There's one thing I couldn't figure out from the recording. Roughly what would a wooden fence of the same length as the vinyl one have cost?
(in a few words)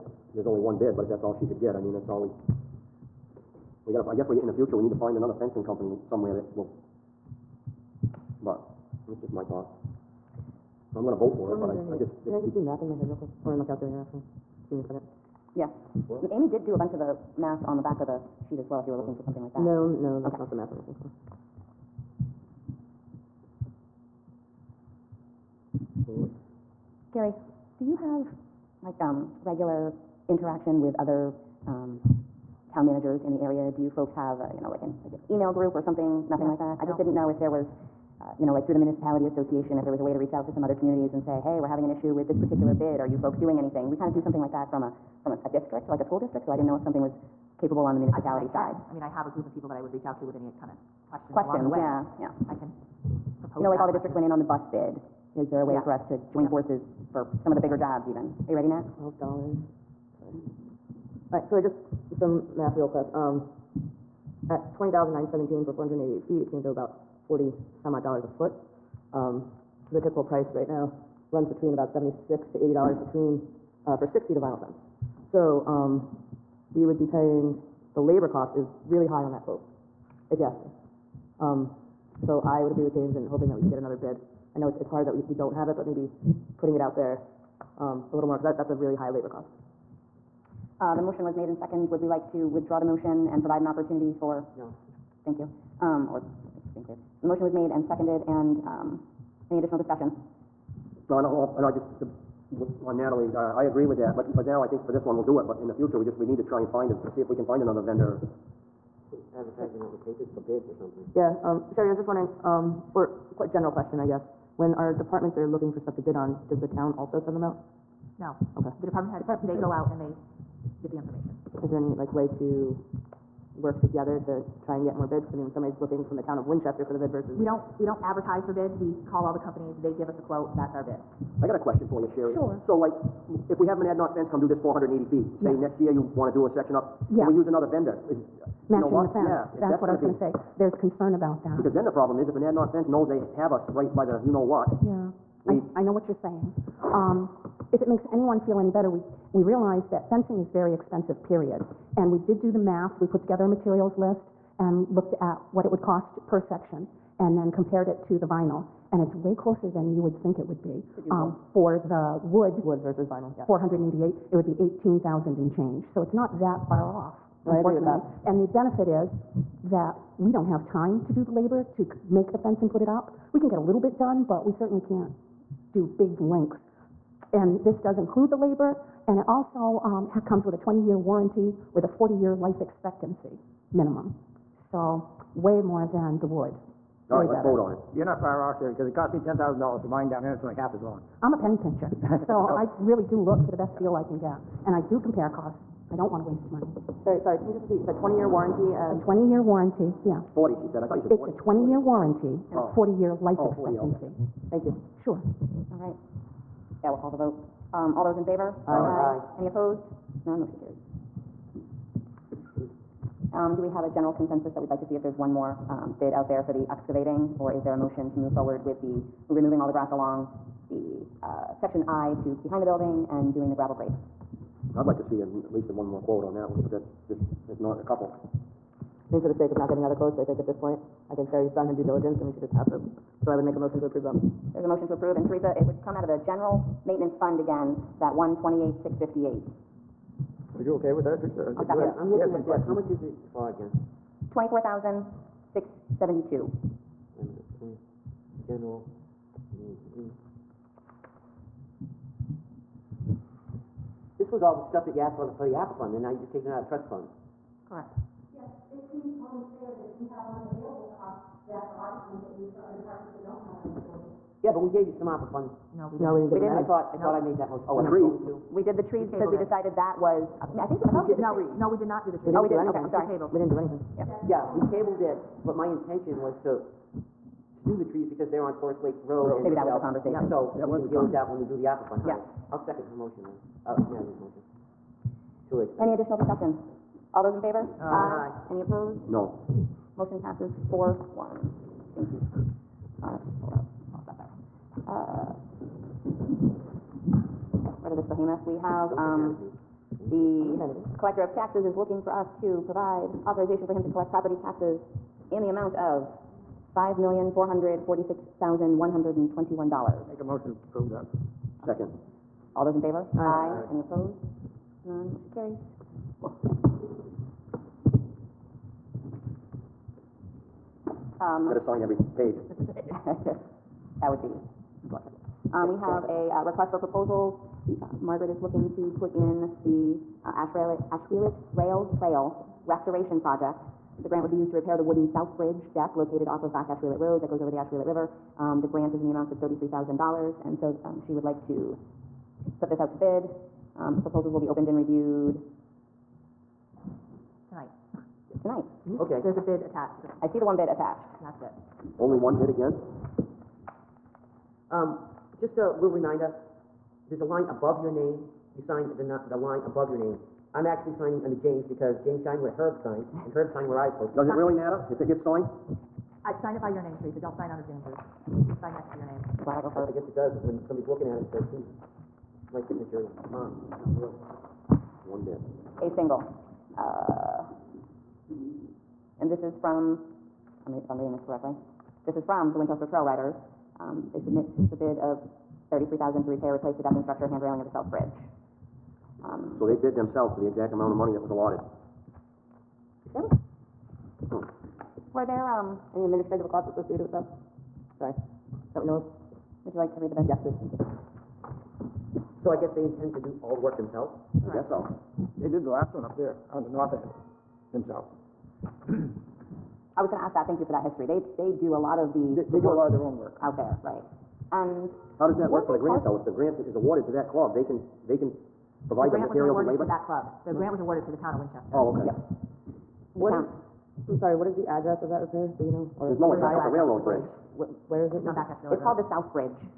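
18,000.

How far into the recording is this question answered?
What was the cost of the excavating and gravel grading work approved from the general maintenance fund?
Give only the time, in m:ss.
4:04.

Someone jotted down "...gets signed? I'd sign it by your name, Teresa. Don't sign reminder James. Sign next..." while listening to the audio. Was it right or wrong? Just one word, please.
wrong.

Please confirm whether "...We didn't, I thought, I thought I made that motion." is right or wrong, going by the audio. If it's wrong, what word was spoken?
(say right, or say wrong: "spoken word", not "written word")
right.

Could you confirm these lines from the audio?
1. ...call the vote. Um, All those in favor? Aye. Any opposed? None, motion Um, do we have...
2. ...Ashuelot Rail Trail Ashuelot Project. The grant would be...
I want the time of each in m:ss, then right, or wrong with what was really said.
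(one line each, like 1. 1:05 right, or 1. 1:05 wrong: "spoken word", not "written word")
1. 3:27 right
2. 5:30 wrong: "Restoration", not "Ashuelot".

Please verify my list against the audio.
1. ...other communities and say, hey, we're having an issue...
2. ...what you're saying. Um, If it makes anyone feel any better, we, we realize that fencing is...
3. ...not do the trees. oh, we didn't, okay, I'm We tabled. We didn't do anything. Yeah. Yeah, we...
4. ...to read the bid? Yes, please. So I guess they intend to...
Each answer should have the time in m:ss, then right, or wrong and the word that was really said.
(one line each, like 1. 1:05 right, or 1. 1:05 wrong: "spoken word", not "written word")
1. 0:40 right
2. 2:25 right
3. 4:31 right
4. 6:39 right.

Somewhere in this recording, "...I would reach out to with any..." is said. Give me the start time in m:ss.
0:49.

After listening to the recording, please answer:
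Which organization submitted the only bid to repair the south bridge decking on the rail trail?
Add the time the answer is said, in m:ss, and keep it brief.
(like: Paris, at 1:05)
Winchester Trail Riders, at 6:22.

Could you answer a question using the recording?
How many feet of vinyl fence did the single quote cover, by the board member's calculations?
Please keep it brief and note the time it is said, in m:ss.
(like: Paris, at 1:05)
488 feet, at 1:05.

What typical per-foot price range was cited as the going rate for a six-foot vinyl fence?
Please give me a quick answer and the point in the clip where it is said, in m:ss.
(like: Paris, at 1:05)
76 to 80 dollars, at 1:11.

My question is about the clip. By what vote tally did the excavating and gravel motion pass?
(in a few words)
4 to 1.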